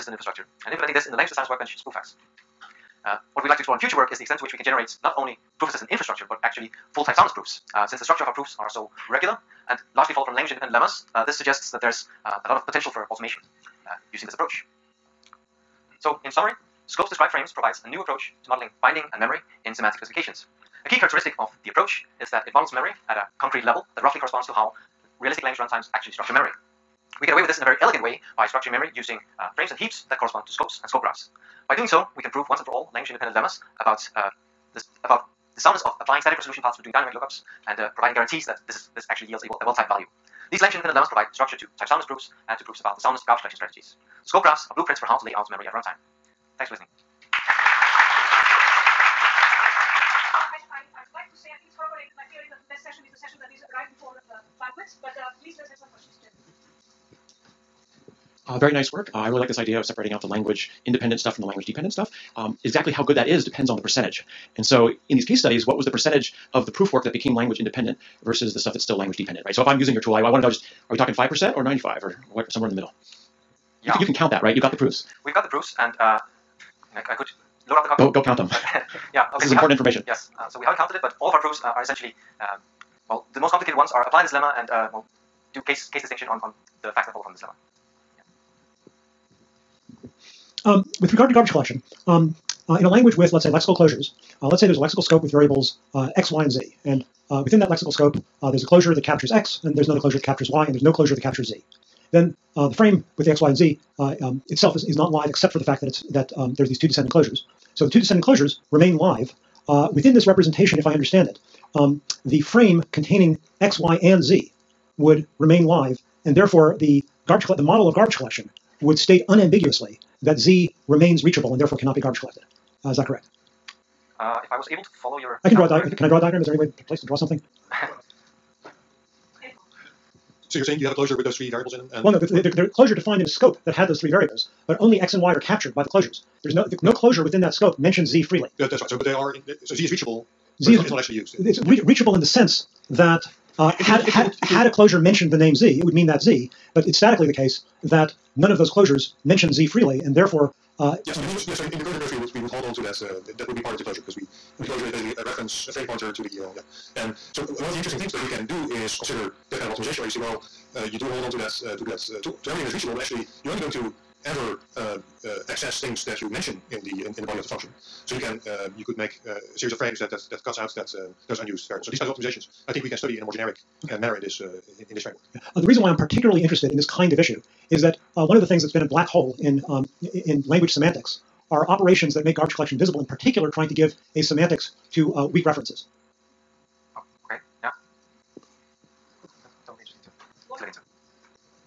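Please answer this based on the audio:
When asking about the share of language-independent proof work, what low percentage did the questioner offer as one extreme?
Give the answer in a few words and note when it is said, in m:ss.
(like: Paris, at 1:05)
5%, at 1:11.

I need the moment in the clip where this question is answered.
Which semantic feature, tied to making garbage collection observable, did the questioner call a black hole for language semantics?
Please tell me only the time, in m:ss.
3:05.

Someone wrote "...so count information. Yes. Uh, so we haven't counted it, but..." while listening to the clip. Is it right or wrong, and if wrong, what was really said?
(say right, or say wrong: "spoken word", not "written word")
wrong: "important", not "count".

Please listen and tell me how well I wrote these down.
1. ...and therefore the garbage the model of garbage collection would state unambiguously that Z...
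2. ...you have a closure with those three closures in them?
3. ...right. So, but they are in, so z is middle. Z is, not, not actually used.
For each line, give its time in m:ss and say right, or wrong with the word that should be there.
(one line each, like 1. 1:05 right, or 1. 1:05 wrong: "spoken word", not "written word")
1. 1:56 right
2. 2:10 wrong: "variables", not "closures"
3. 2:18 wrong: "reachable", not "middle".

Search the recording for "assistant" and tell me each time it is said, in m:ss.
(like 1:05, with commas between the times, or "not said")
0:05.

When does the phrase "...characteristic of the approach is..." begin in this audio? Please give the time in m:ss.
0:20.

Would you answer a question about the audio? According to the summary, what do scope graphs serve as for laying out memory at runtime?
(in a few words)
Blueprints.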